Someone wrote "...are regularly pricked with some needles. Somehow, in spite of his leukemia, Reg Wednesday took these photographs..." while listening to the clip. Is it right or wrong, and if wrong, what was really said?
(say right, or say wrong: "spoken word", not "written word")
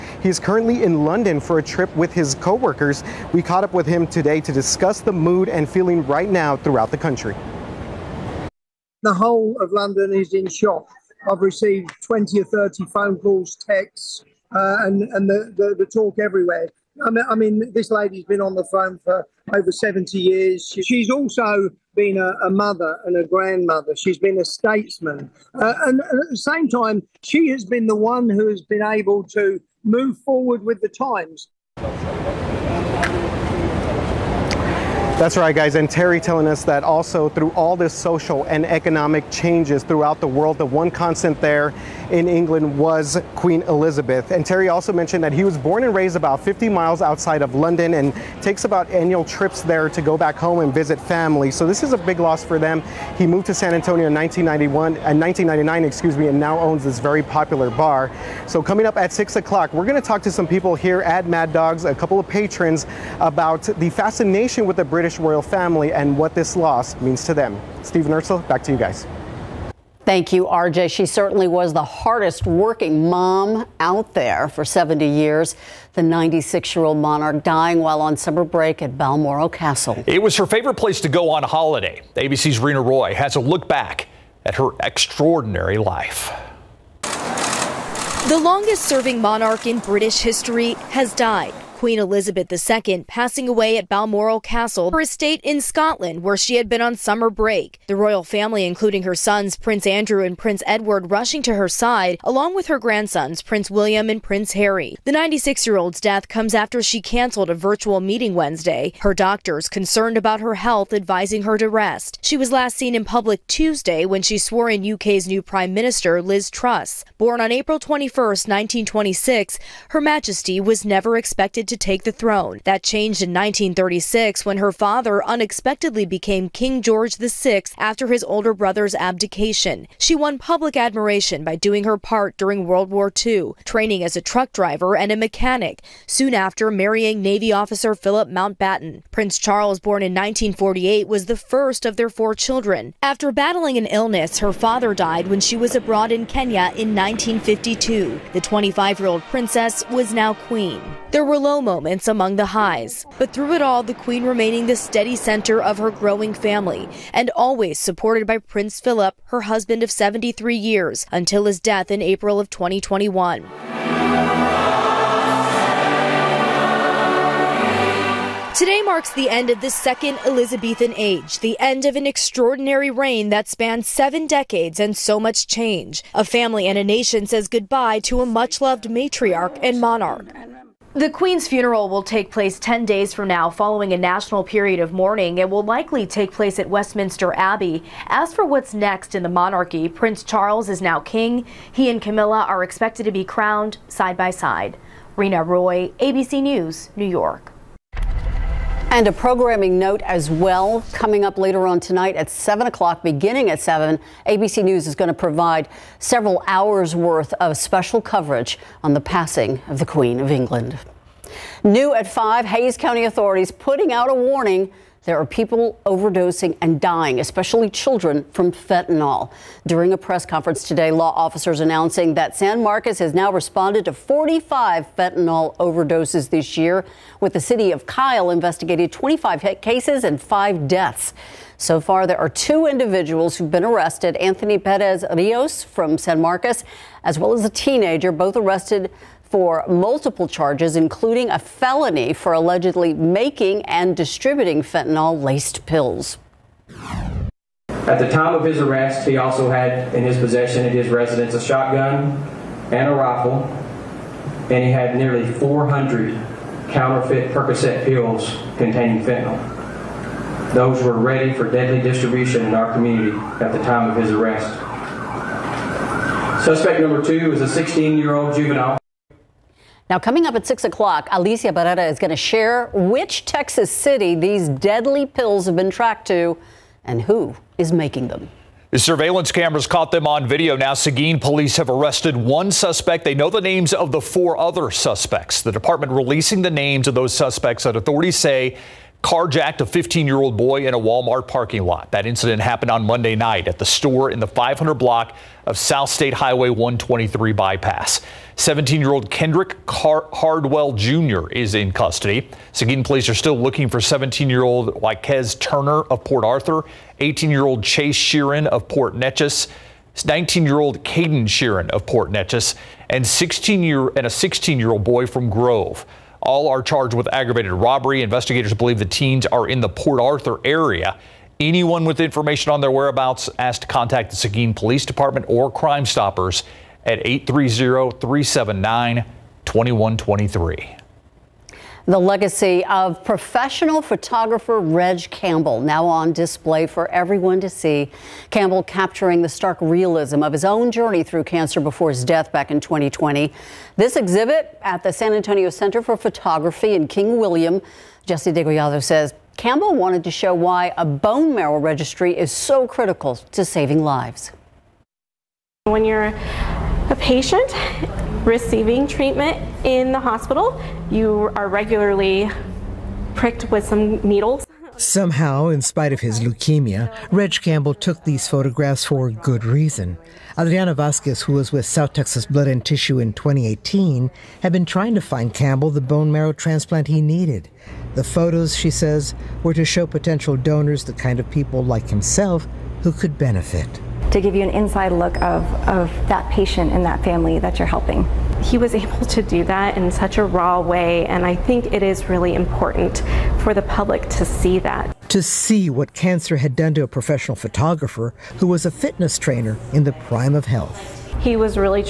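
wrong: "Campbell", not "Wednesday".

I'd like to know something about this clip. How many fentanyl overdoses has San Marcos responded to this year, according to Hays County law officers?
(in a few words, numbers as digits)
45.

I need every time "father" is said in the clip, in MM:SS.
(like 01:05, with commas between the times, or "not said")
02:04, 02:24.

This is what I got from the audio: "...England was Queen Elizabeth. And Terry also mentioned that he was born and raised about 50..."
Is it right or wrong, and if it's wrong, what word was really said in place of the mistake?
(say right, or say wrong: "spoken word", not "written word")
right.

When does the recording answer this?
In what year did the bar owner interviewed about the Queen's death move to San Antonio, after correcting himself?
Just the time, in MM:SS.
00:55.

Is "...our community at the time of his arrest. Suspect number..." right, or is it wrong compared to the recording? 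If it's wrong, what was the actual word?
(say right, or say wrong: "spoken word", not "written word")
right.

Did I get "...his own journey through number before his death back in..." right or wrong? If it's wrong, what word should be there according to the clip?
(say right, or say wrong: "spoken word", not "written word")
wrong: "cancer", not "number".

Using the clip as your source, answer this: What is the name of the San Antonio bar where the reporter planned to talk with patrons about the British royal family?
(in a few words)
Mad Dogs.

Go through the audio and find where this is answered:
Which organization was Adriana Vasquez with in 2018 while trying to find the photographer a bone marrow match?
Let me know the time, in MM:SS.
06:11.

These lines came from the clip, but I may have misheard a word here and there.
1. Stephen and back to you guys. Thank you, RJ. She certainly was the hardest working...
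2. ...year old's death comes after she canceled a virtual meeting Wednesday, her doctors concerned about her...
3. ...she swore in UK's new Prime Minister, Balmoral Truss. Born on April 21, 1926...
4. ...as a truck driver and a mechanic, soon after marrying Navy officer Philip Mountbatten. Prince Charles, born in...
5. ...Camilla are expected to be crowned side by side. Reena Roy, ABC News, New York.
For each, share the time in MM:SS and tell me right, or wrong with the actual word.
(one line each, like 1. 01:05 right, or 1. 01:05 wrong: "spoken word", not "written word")
1. 01:07 right
2. 01:45 right
3. 01:54 wrong: "Liz", not "Balmoral"
4. 02:14 right
5. 03:11 right.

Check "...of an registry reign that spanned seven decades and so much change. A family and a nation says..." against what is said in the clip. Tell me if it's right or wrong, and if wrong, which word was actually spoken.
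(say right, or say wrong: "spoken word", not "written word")
wrong: "extraordinary", not "registry".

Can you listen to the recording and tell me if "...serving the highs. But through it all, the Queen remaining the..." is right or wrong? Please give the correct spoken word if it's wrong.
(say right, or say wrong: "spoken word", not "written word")
wrong: "among", not "serving".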